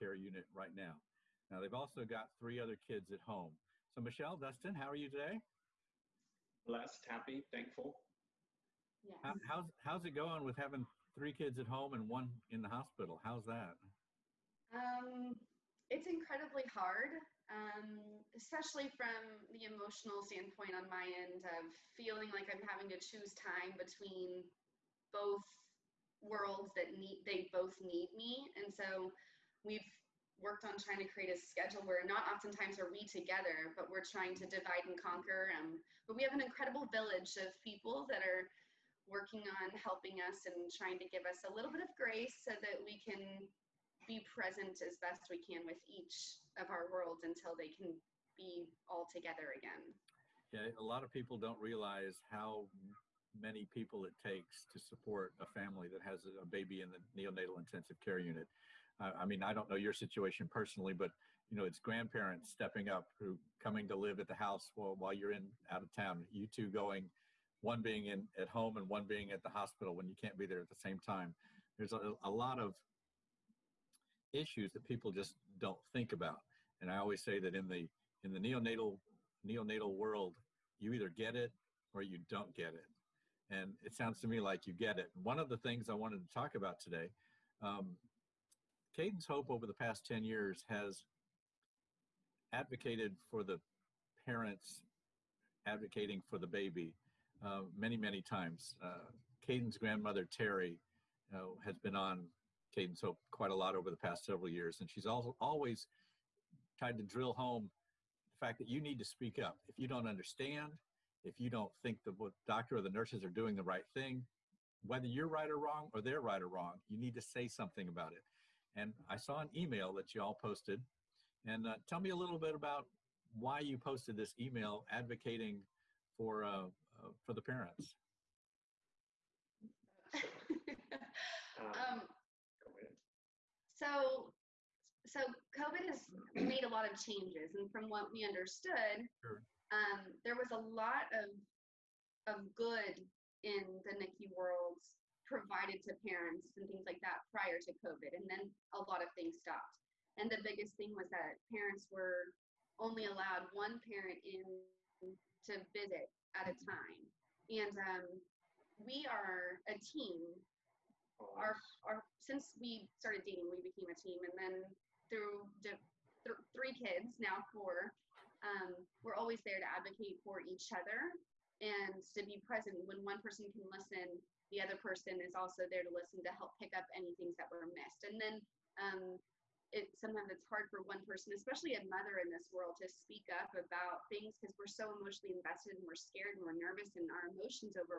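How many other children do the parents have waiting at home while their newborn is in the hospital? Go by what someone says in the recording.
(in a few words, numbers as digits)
3.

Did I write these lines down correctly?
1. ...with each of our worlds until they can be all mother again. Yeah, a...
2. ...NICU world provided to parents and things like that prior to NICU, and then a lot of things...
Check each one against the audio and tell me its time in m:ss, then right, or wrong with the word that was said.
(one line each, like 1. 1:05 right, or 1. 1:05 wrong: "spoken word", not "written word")
1. 0:45 wrong: "together", not "mother"
2. 2:23 wrong: "COVID", not "NICU".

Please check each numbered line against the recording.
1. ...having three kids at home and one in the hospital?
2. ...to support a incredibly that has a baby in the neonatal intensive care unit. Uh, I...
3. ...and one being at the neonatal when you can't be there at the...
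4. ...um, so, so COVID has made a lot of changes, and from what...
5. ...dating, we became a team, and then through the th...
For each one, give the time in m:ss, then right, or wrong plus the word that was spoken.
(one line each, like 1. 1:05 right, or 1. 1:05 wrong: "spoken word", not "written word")
1. 0:10 right
2. 0:54 wrong: "family", not "incredibly"
3. 1:08 wrong: "hospital", not "neonatal"
4. 2:11 right
5. 2:43 right.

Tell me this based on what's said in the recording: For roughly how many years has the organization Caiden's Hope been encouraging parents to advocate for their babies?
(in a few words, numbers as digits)
10 years.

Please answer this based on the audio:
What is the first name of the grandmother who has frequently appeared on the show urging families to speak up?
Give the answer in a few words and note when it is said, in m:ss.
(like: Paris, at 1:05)
Terry, at 1:40.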